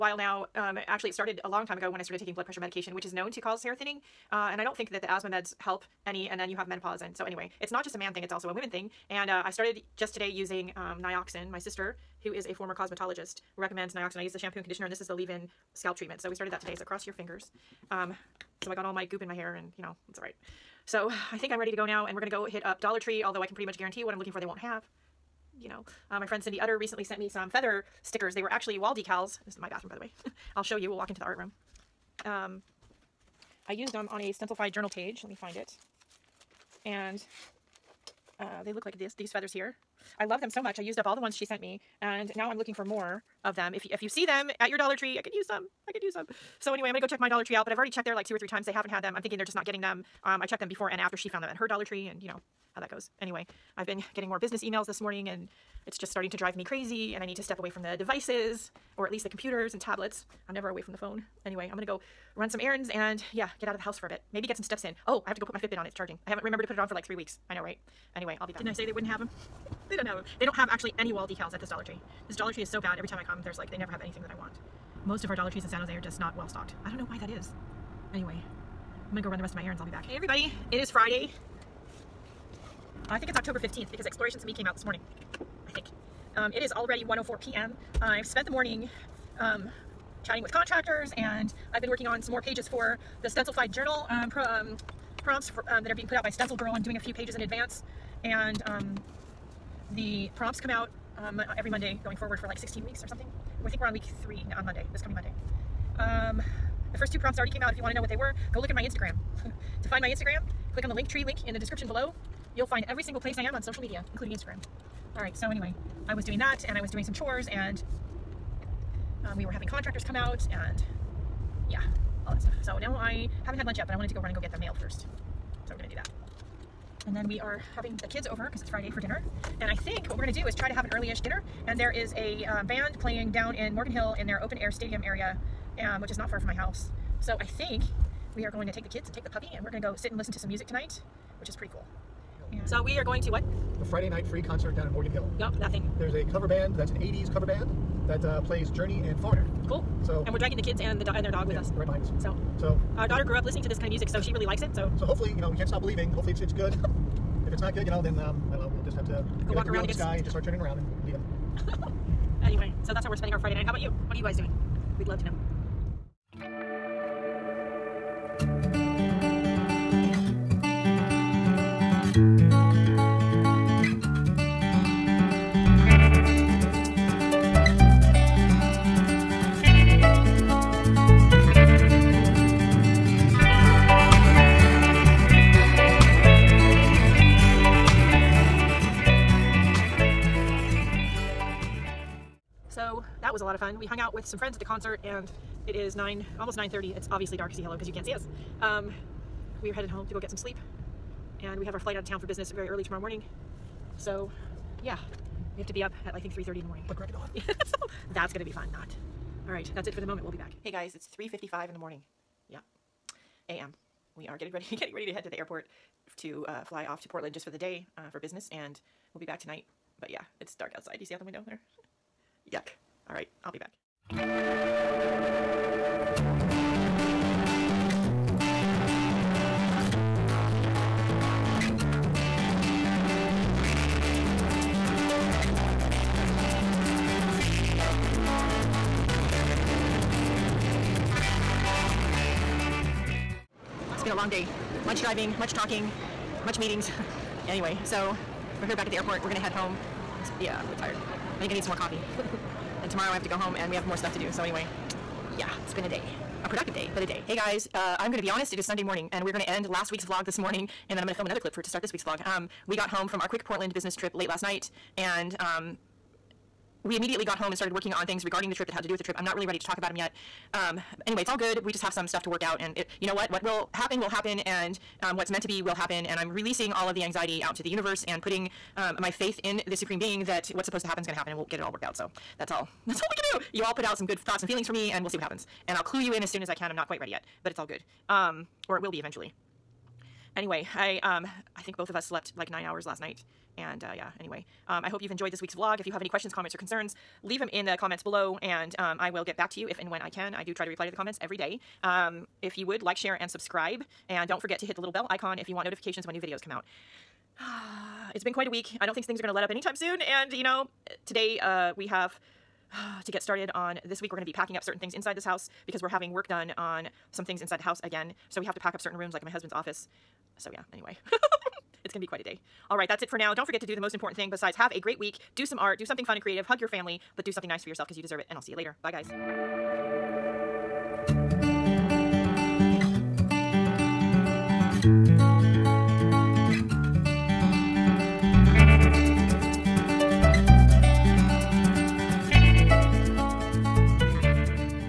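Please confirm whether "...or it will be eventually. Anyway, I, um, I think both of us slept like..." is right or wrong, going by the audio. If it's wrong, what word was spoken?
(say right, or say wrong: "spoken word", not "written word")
right.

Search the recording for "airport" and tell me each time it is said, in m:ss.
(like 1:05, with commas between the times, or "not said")
3:35, 4:08.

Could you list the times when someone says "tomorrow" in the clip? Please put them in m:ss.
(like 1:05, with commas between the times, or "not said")
3:22, 4:12.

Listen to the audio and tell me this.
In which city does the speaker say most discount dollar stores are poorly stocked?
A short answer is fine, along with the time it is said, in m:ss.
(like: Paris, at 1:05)
San Jose, at 1:15.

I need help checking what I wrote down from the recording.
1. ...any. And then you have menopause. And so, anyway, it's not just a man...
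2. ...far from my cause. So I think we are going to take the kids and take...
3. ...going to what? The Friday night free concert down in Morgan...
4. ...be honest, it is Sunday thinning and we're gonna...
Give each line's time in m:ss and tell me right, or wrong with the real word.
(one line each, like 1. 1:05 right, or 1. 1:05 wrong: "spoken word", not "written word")
1. 0:06 right
2. 2:16 wrong: "house", not "cause"
3. 2:23 right
4. 4:18 wrong: "morning", not "thinning".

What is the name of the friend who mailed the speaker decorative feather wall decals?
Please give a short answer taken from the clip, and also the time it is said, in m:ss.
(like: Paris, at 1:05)
Cindy Utter, at 0:26.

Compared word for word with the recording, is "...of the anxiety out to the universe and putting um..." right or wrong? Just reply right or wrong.
right.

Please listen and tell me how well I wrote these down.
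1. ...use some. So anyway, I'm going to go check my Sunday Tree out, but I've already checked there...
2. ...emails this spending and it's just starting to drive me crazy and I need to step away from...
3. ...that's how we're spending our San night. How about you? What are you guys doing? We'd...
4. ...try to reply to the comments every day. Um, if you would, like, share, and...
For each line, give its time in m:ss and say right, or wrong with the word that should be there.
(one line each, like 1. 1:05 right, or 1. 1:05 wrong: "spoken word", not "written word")
1. 0:46 wrong: "Dollar", not "Sunday"
2. 0:54 wrong: "morning", not "spending"
3. 2:42 wrong: "Friday", not "San"
4. 5:00 right.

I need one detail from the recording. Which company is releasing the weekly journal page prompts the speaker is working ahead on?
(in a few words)
Stencil Girl.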